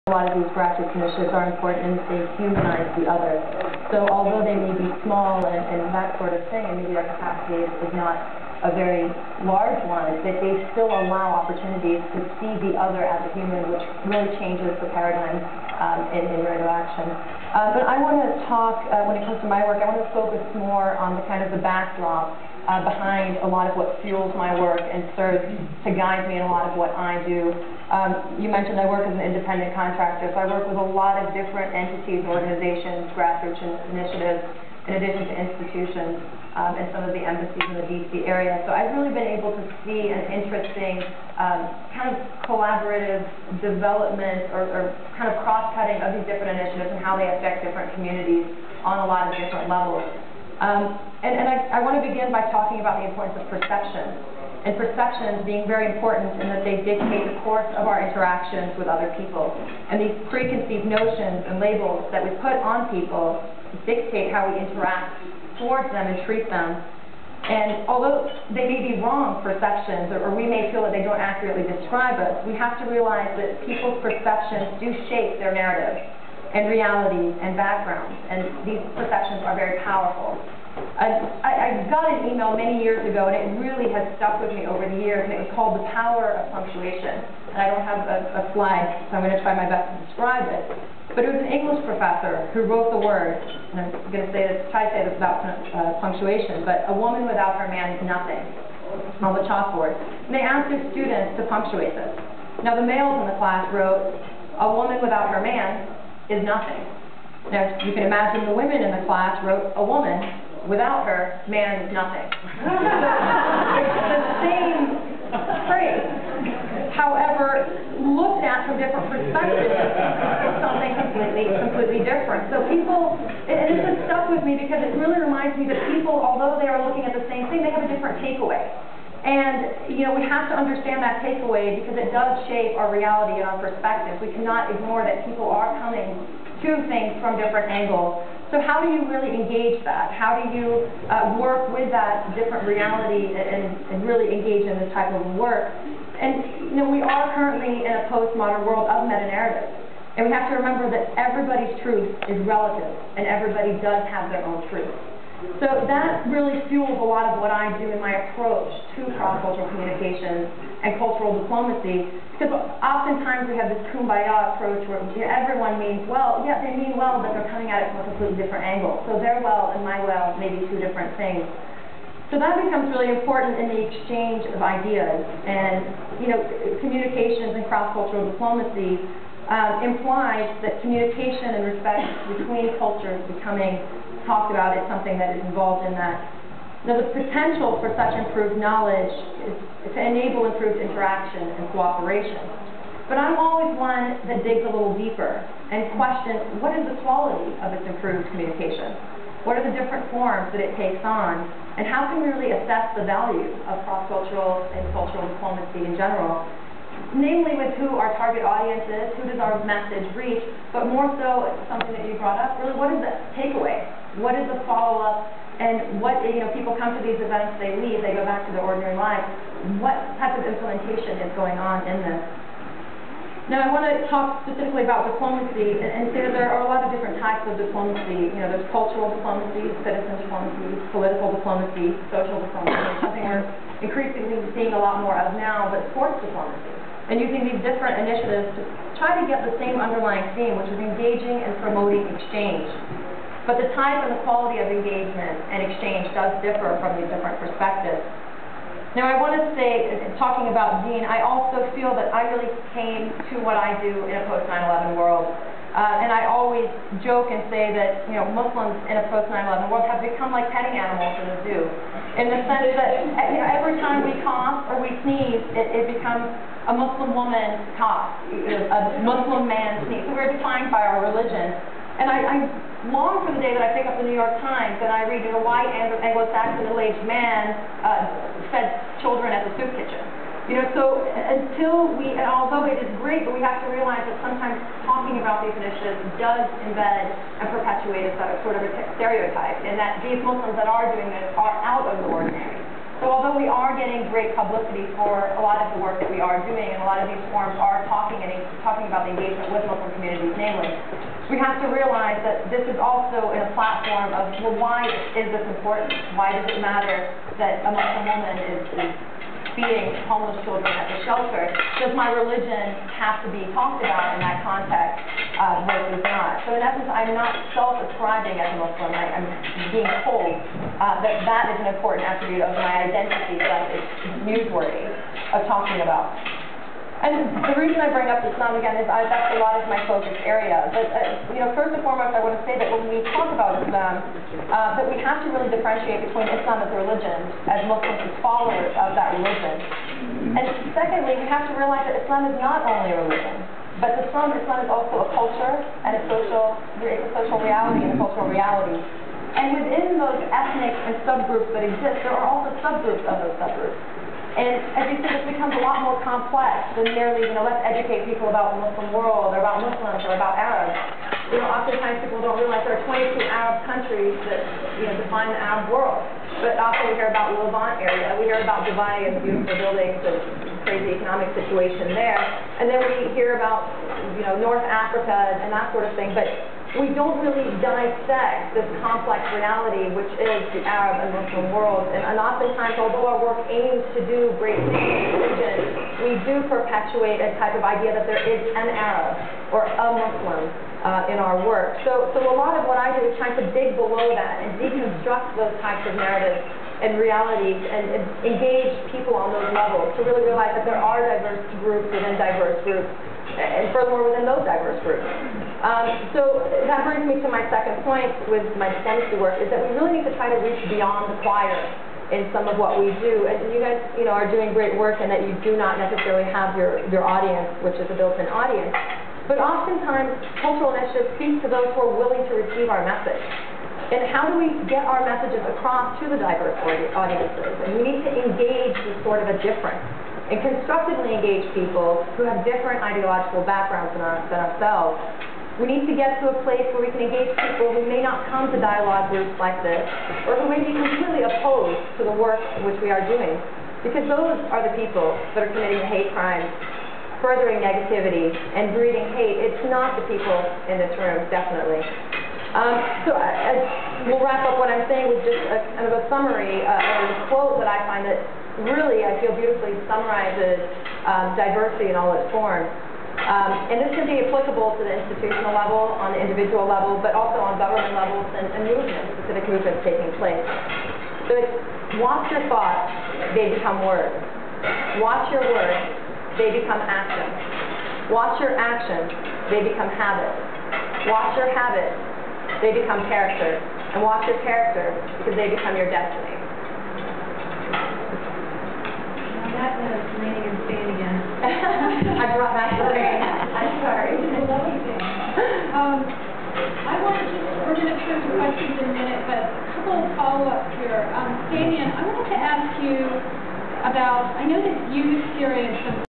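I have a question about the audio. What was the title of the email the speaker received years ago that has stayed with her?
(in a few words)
The Power of Punctuation.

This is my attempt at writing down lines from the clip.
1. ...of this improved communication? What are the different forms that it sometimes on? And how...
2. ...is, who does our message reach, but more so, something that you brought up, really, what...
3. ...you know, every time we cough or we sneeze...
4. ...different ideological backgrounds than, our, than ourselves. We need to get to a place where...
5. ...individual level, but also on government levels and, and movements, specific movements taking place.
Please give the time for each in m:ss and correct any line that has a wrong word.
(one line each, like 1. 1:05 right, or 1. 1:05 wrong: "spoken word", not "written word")
1. 3:17 wrong: "takes", not "sometimes"
2. 3:28 right
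3. 4:23 right
4. 7:12 right
5. 7:46 right.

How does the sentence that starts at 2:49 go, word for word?
So their well and my well may be two different things.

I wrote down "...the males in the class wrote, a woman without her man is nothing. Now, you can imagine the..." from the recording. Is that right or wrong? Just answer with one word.
right.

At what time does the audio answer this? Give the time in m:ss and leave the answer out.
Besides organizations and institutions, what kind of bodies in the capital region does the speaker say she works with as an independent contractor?
0:37.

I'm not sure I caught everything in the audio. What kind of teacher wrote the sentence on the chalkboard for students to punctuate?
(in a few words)
English professor.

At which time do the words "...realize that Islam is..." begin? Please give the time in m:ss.
5:41.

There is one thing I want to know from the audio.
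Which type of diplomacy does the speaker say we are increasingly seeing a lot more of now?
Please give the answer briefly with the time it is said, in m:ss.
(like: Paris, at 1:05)
sports diplomacy, at 3:55.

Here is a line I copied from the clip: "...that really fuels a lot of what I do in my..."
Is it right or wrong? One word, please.
right.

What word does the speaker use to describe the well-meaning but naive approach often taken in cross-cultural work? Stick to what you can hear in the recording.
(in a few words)
kumbaya.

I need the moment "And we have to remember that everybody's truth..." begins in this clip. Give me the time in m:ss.
2:30.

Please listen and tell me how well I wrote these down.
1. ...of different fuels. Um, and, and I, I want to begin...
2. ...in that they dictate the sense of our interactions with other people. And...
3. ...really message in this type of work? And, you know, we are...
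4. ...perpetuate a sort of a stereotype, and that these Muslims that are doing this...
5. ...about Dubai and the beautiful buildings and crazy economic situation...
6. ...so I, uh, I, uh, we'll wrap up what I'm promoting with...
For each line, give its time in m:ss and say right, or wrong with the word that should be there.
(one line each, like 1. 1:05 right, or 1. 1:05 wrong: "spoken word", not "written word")
1. 0:49 wrong: "levels", not "fuels"
2. 0:56 wrong: "course", not "sense"
3. 2:24 wrong: "engage", not "message"
4. 4:47 right
5. 6:08 right
6. 7:33 wrong: "saying", not "promoting".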